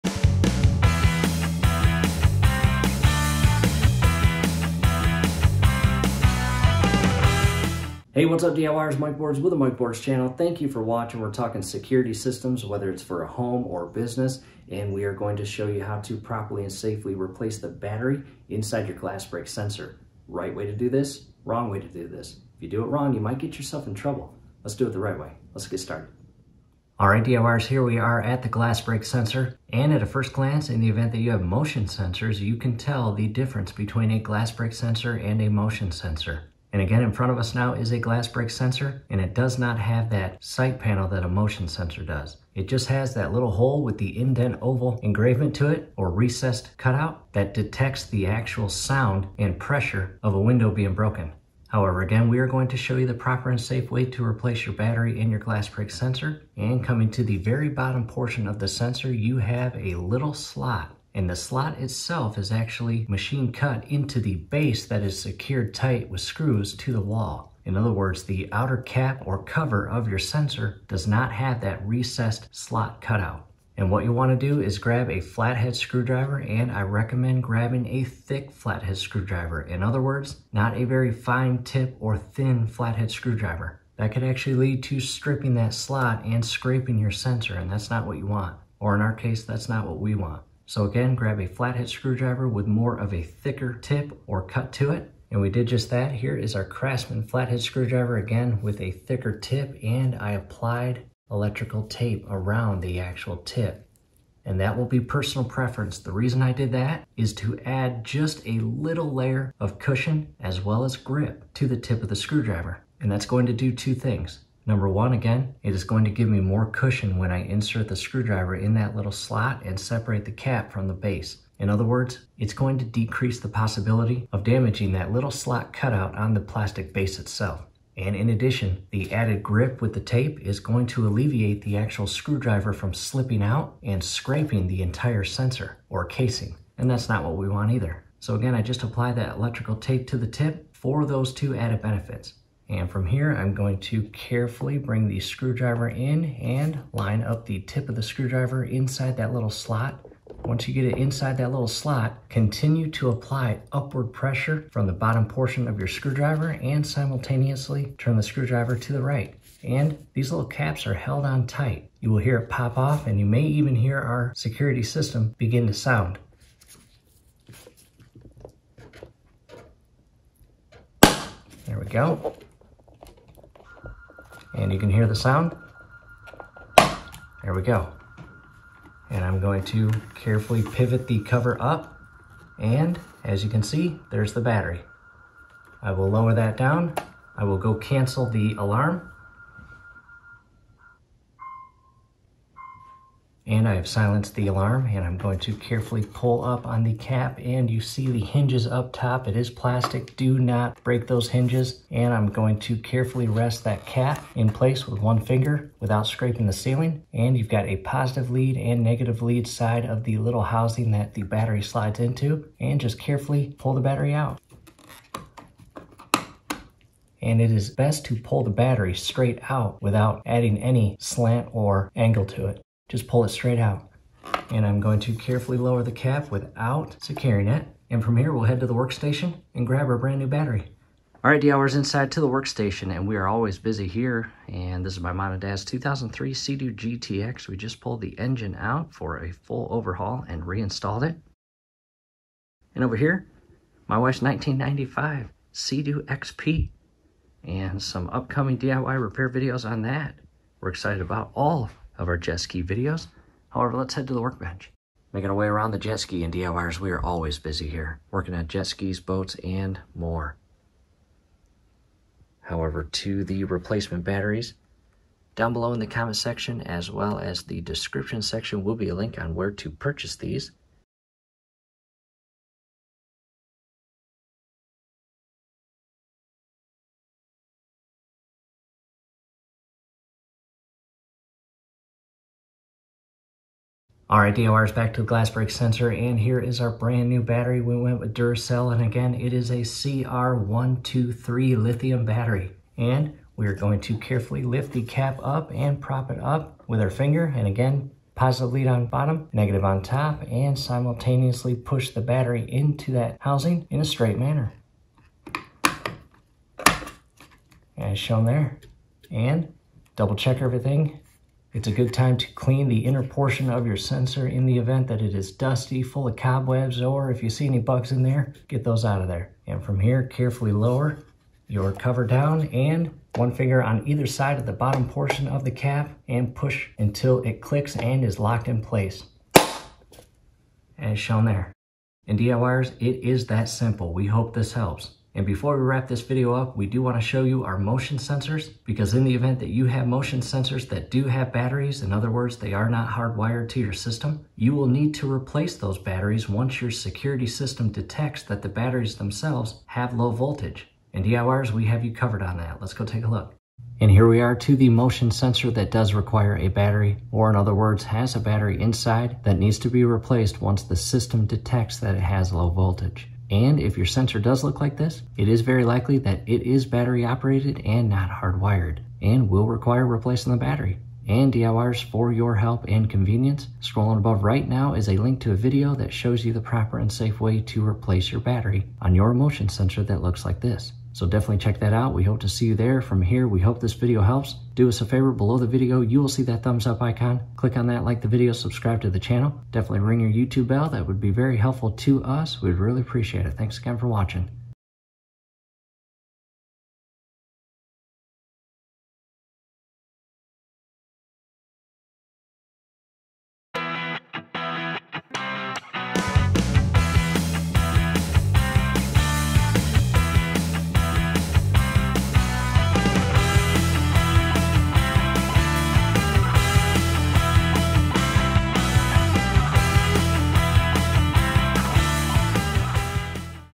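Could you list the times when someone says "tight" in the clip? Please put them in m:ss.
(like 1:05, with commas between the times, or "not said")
1:05, 2:41.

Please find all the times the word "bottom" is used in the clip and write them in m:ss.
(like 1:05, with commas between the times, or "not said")
0:57, 2:34, 4:58, 5:24.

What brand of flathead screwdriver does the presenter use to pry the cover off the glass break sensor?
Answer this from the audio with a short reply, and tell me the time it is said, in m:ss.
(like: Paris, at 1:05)
Craftsman, at 1:36.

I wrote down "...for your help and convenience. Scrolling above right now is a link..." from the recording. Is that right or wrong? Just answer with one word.
right.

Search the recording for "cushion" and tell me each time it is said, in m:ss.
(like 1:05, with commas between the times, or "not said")
1:49, 1:56.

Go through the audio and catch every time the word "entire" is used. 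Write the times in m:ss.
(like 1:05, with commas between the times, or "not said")
2:14.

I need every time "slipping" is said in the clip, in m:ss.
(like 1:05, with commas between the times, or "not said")
2:12.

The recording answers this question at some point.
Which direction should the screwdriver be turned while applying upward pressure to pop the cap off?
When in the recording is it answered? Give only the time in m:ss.
2:38.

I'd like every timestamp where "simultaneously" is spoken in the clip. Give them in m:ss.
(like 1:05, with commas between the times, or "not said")
2:36, 5:00.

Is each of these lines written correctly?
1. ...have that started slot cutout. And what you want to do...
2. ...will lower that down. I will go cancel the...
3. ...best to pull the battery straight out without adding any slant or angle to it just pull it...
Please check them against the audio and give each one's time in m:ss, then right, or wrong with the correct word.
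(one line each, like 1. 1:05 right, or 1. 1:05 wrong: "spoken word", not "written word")
1. 1:11 wrong: "recessed", not "started"
2. 3:05 right
3. 3:37 right.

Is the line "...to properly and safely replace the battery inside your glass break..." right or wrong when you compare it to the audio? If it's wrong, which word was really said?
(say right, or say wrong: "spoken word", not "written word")
right.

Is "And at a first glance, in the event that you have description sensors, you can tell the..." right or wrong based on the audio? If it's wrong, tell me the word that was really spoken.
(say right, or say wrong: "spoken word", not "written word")
wrong: "motion", not "description".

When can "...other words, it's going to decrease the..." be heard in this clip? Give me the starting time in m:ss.
2:01.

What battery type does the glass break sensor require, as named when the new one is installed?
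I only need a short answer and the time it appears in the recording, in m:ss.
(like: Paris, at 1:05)
CR123 lithium, at 4:49.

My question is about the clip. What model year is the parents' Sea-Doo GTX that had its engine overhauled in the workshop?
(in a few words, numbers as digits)
2003.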